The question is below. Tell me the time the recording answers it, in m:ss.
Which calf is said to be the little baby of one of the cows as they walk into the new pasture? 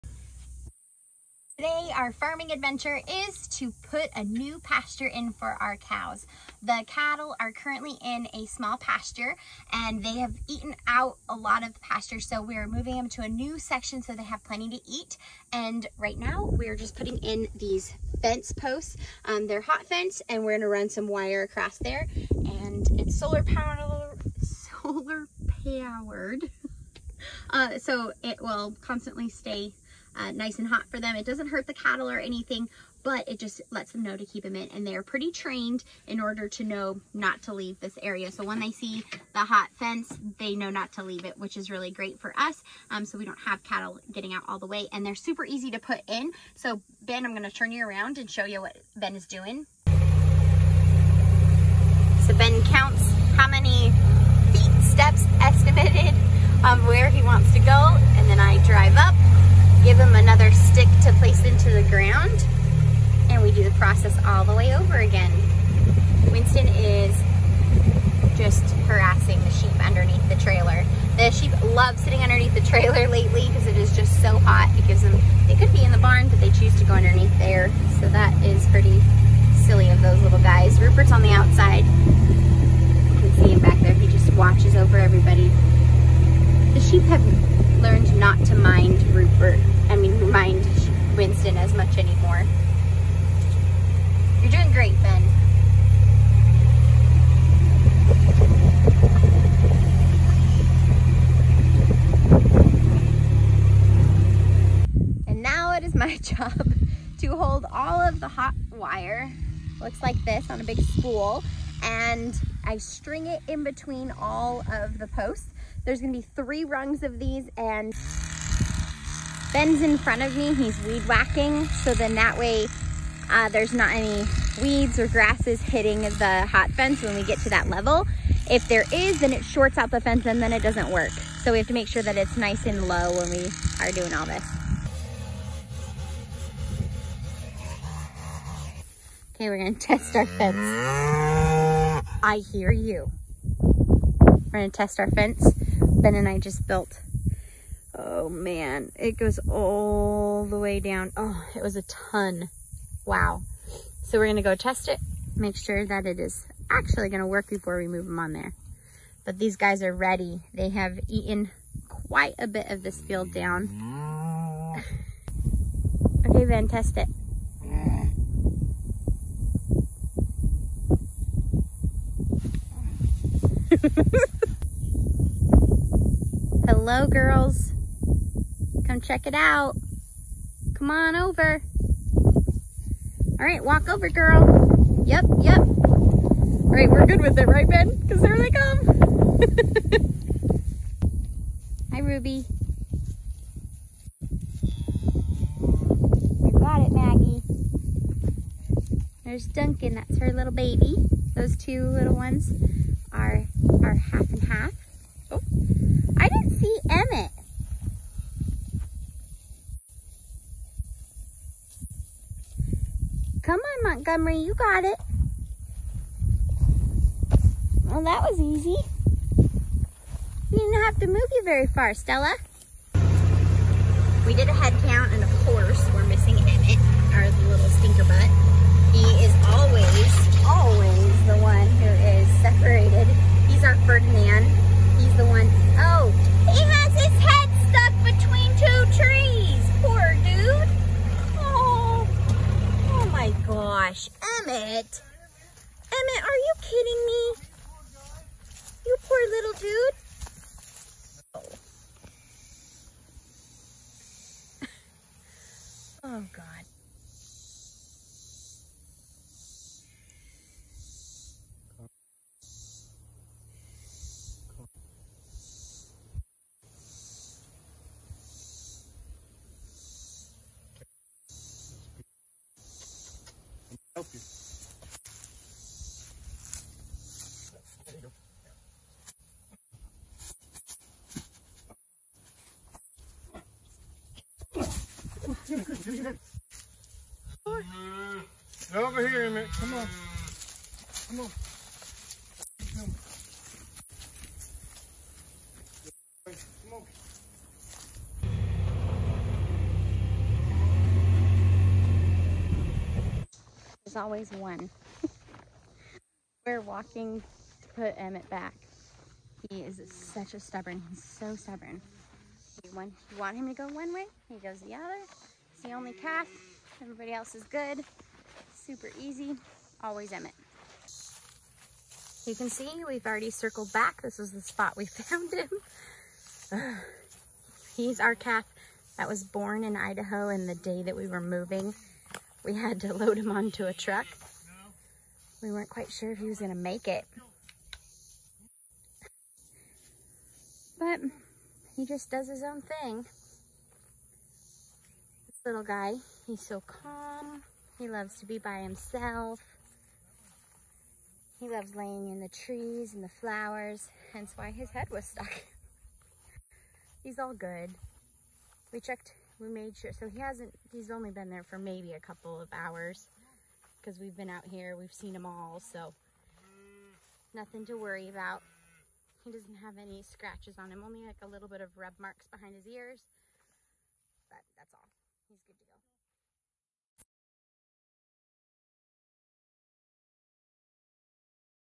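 3:19.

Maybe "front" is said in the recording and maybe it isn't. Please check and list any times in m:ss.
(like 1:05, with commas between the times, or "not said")
1:59.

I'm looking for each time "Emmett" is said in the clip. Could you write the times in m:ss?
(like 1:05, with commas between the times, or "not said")
4:49, 5:07, 5:20.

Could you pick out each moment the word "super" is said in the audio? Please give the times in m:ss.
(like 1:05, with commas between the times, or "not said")
0:45, 5:18.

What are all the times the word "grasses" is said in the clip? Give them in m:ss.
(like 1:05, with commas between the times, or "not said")
2:05.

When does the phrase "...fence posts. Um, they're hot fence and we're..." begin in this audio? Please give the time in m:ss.
0:18.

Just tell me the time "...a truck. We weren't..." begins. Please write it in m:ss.
5:33.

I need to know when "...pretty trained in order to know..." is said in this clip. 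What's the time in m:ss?
0:35.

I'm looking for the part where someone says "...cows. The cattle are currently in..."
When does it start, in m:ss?
0:05.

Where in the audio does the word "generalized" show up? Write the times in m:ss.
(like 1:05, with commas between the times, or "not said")
not said.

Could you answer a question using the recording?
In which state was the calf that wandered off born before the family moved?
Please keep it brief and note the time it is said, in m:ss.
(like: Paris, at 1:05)
Idaho, at 5:29.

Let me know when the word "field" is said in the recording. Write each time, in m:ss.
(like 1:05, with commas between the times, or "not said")
2:43.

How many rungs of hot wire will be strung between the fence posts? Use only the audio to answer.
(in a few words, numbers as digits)
3.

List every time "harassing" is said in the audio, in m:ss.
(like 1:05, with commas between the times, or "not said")
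1:08.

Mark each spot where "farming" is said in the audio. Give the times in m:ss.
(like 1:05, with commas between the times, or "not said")
0:02.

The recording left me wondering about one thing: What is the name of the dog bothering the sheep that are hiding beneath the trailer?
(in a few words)
Winston.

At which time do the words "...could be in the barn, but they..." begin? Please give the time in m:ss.
1:15.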